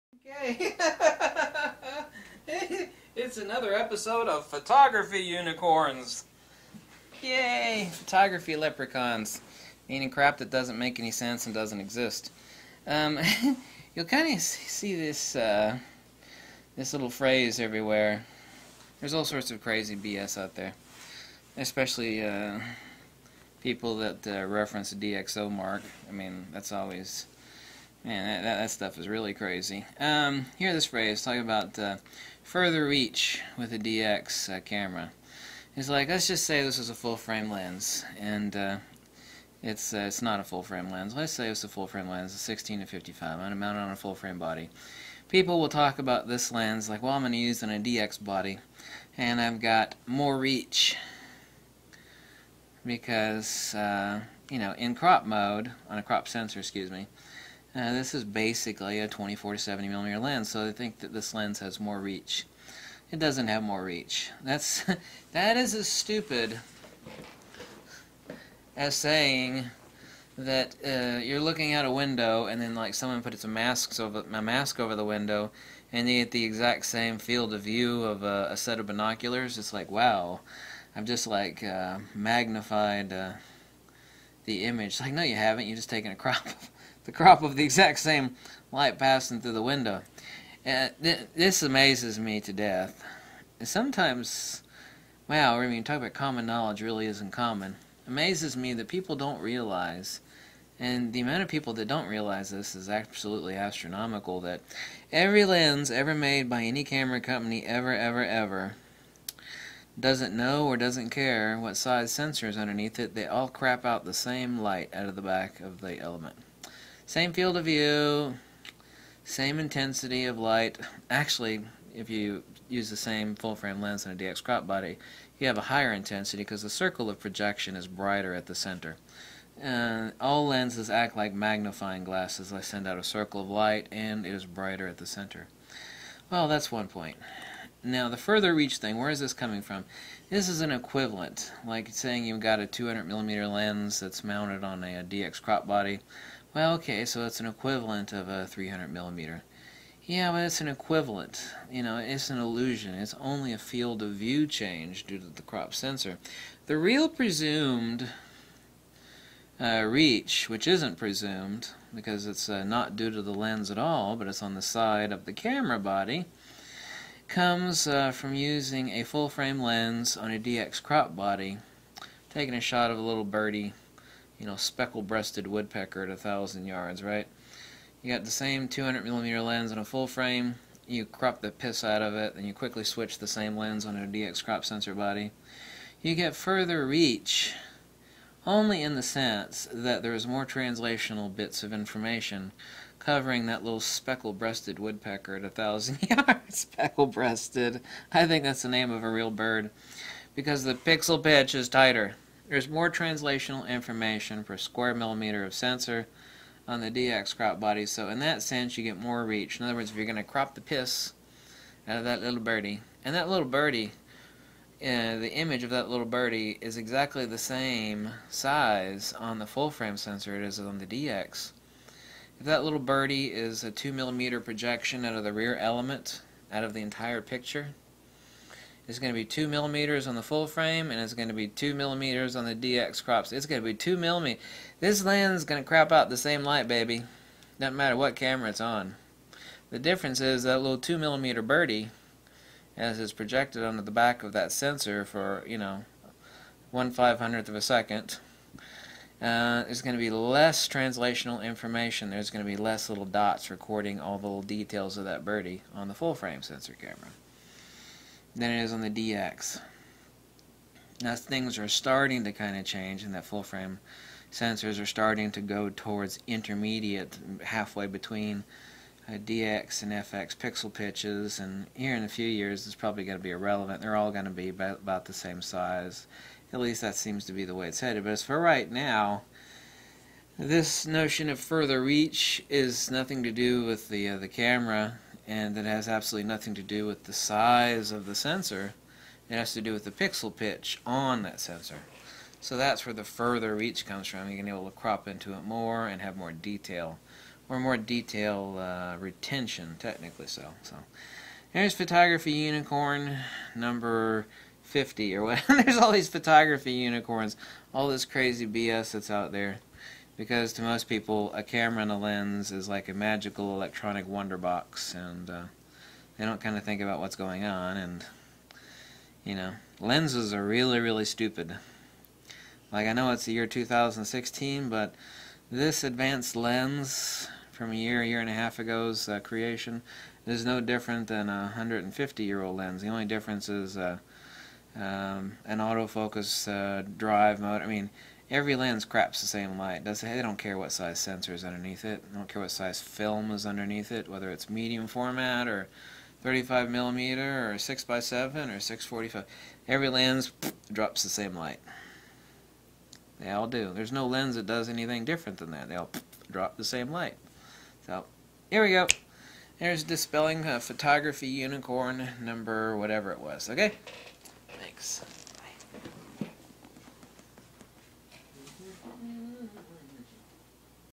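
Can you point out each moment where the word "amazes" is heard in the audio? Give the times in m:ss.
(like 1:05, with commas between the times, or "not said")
1:31, 1:38.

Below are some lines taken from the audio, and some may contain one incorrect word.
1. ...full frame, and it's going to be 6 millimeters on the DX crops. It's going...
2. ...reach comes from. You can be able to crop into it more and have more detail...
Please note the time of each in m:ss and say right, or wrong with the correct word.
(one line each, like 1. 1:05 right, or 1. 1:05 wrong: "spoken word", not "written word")
1. 3:50 wrong: "2", not "6"
2. 4:53 right.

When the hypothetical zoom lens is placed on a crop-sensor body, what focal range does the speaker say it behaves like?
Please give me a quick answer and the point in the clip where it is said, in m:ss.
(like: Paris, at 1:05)
24 to 70 millimeter, at 0:59.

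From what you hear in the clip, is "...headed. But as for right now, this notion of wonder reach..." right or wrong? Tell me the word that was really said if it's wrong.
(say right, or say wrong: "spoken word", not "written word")
wrong: "further", not "wonder".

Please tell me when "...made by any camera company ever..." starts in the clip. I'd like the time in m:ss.
1:46.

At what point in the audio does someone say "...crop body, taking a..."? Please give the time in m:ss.
2:50.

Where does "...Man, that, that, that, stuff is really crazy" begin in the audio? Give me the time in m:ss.
0:28.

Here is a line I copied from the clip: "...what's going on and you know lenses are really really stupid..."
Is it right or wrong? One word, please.
right.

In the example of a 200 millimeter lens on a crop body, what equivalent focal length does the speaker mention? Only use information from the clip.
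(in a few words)
300 millimeter.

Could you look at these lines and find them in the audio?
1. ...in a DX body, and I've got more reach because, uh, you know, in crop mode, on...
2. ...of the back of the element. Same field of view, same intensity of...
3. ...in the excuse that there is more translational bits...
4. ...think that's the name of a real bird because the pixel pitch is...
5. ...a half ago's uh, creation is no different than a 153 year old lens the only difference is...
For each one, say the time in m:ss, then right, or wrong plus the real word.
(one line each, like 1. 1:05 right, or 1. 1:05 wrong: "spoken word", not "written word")
1. 0:47 right
2. 1:55 right
3. 3:08 wrong: "sense", not "excuse"
4. 3:18 right
5. 5:28 wrong: "150", not "153".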